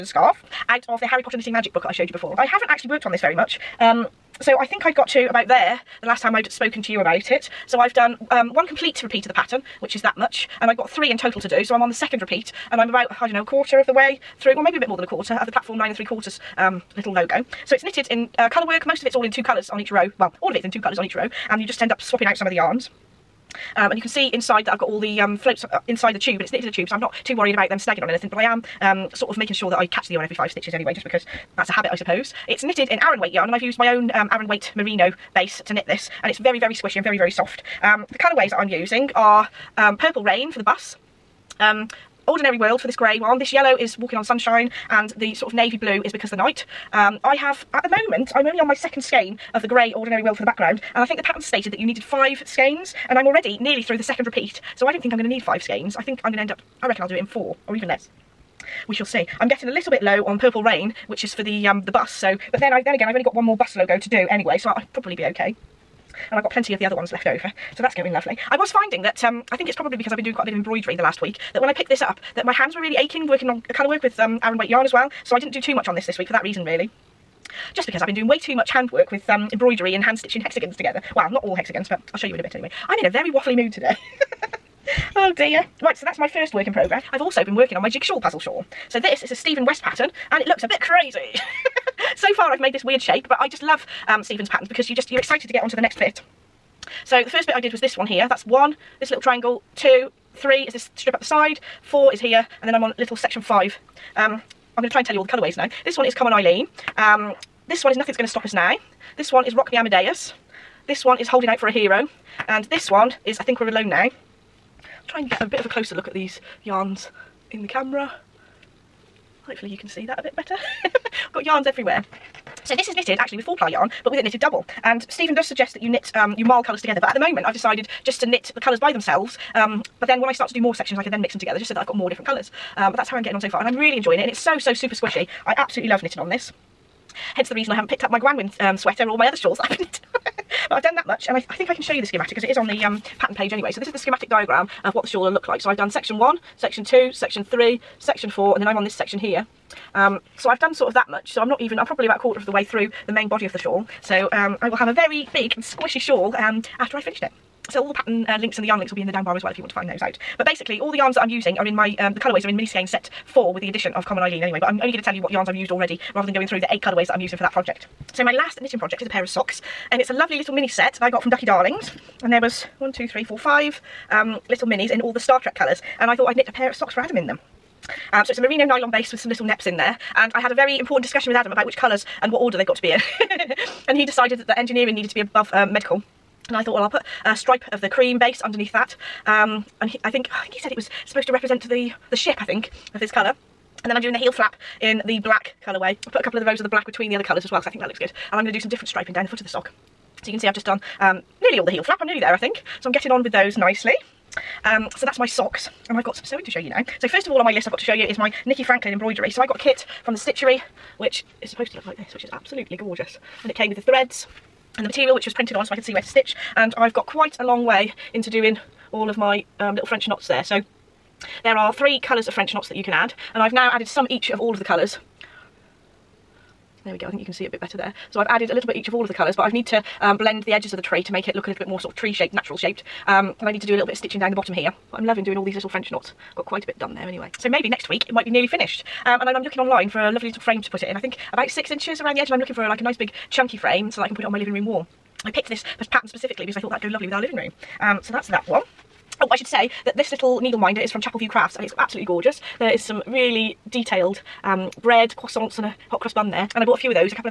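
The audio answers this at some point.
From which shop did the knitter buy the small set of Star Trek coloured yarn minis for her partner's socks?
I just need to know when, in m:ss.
2:51.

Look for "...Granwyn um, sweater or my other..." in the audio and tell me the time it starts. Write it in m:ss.
2:18.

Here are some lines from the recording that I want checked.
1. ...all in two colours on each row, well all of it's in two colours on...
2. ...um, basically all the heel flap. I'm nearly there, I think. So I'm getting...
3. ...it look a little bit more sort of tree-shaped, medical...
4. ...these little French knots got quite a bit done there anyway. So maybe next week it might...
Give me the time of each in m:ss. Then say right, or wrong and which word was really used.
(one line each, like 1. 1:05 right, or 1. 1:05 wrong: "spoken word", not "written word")
1. 0:19 right
2. 3:20 wrong: "nearly", not "basically"
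3. 3:51 wrong: "natural", not "medical"
4. 3:55 right.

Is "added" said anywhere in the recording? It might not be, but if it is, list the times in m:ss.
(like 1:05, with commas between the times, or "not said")
3:43, 3:48.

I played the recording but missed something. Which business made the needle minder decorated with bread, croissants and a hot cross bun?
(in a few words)
Chapel View Crafts.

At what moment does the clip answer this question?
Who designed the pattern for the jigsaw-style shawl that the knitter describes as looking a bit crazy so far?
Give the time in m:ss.
1:29.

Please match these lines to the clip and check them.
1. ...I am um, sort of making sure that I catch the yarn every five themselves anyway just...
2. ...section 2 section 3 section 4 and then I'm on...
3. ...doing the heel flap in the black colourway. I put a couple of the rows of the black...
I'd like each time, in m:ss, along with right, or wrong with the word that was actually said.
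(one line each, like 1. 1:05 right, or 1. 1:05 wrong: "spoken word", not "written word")
1. 0:28 wrong: "stitches", not "themselves"
2. 2:26 right
3. 3:14 right.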